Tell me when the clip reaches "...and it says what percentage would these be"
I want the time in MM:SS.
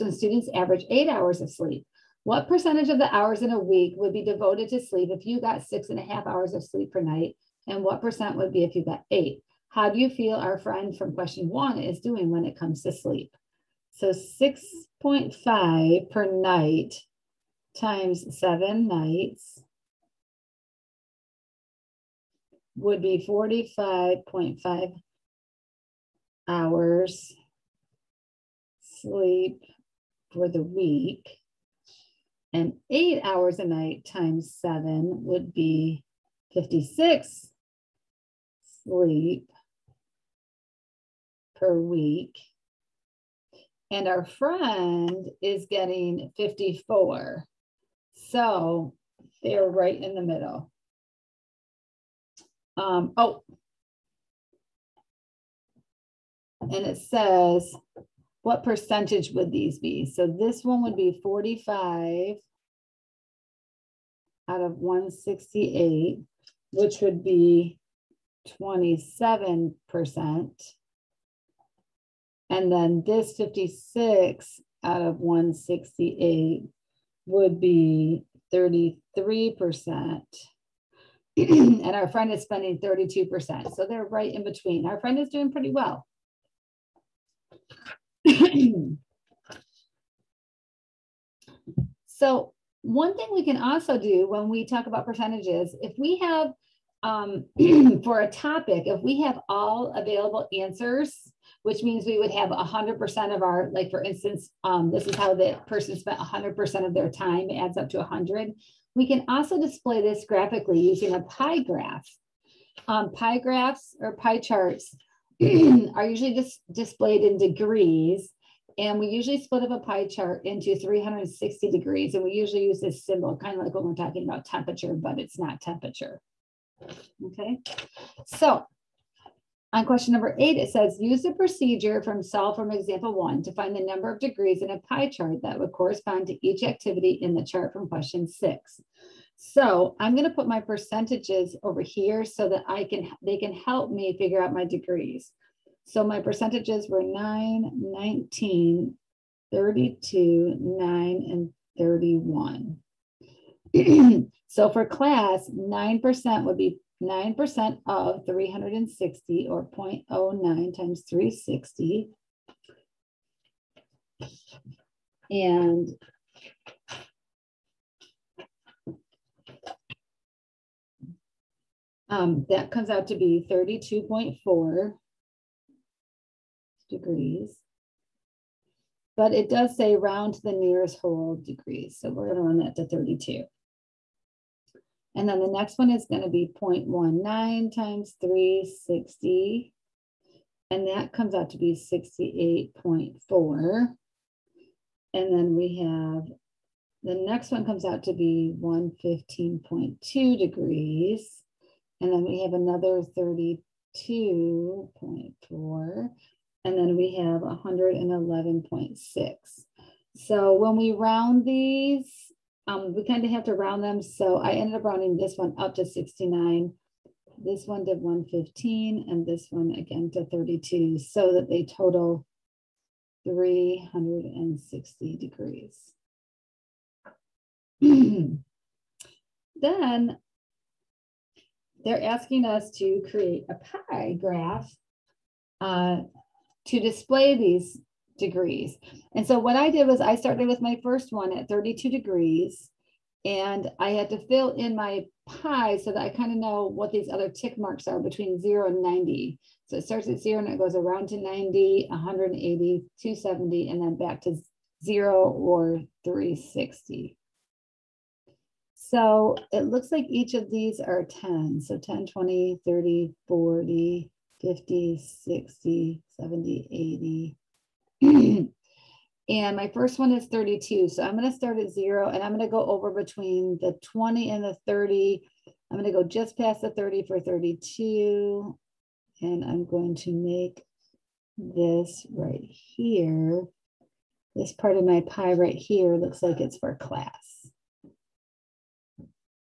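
00:56.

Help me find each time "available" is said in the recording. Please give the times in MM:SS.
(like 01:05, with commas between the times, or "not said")
01:39.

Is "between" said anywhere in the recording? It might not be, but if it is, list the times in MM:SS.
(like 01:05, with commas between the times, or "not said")
01:24, 04:07, 04:32.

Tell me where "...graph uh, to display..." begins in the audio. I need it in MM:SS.
03:54.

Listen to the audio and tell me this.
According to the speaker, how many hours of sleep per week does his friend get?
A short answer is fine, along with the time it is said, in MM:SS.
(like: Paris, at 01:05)
54, at 00:46.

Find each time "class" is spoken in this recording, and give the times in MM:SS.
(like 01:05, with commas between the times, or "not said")
02:34, 04:46.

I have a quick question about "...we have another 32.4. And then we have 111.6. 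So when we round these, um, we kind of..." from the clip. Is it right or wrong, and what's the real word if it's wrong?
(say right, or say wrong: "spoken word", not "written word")
right.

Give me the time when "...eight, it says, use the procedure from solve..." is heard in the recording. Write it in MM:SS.
02:10.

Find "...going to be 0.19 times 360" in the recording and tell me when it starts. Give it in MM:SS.
03:06.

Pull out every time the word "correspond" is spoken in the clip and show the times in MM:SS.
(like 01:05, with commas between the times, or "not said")
02:15.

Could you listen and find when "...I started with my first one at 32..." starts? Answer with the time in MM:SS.
03:59.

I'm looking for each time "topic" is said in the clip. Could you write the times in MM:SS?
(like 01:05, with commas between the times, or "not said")
01:38.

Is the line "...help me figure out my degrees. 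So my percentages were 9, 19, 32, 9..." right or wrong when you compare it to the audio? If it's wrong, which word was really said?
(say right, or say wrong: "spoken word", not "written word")
right.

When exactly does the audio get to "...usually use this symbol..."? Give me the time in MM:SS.
02:02.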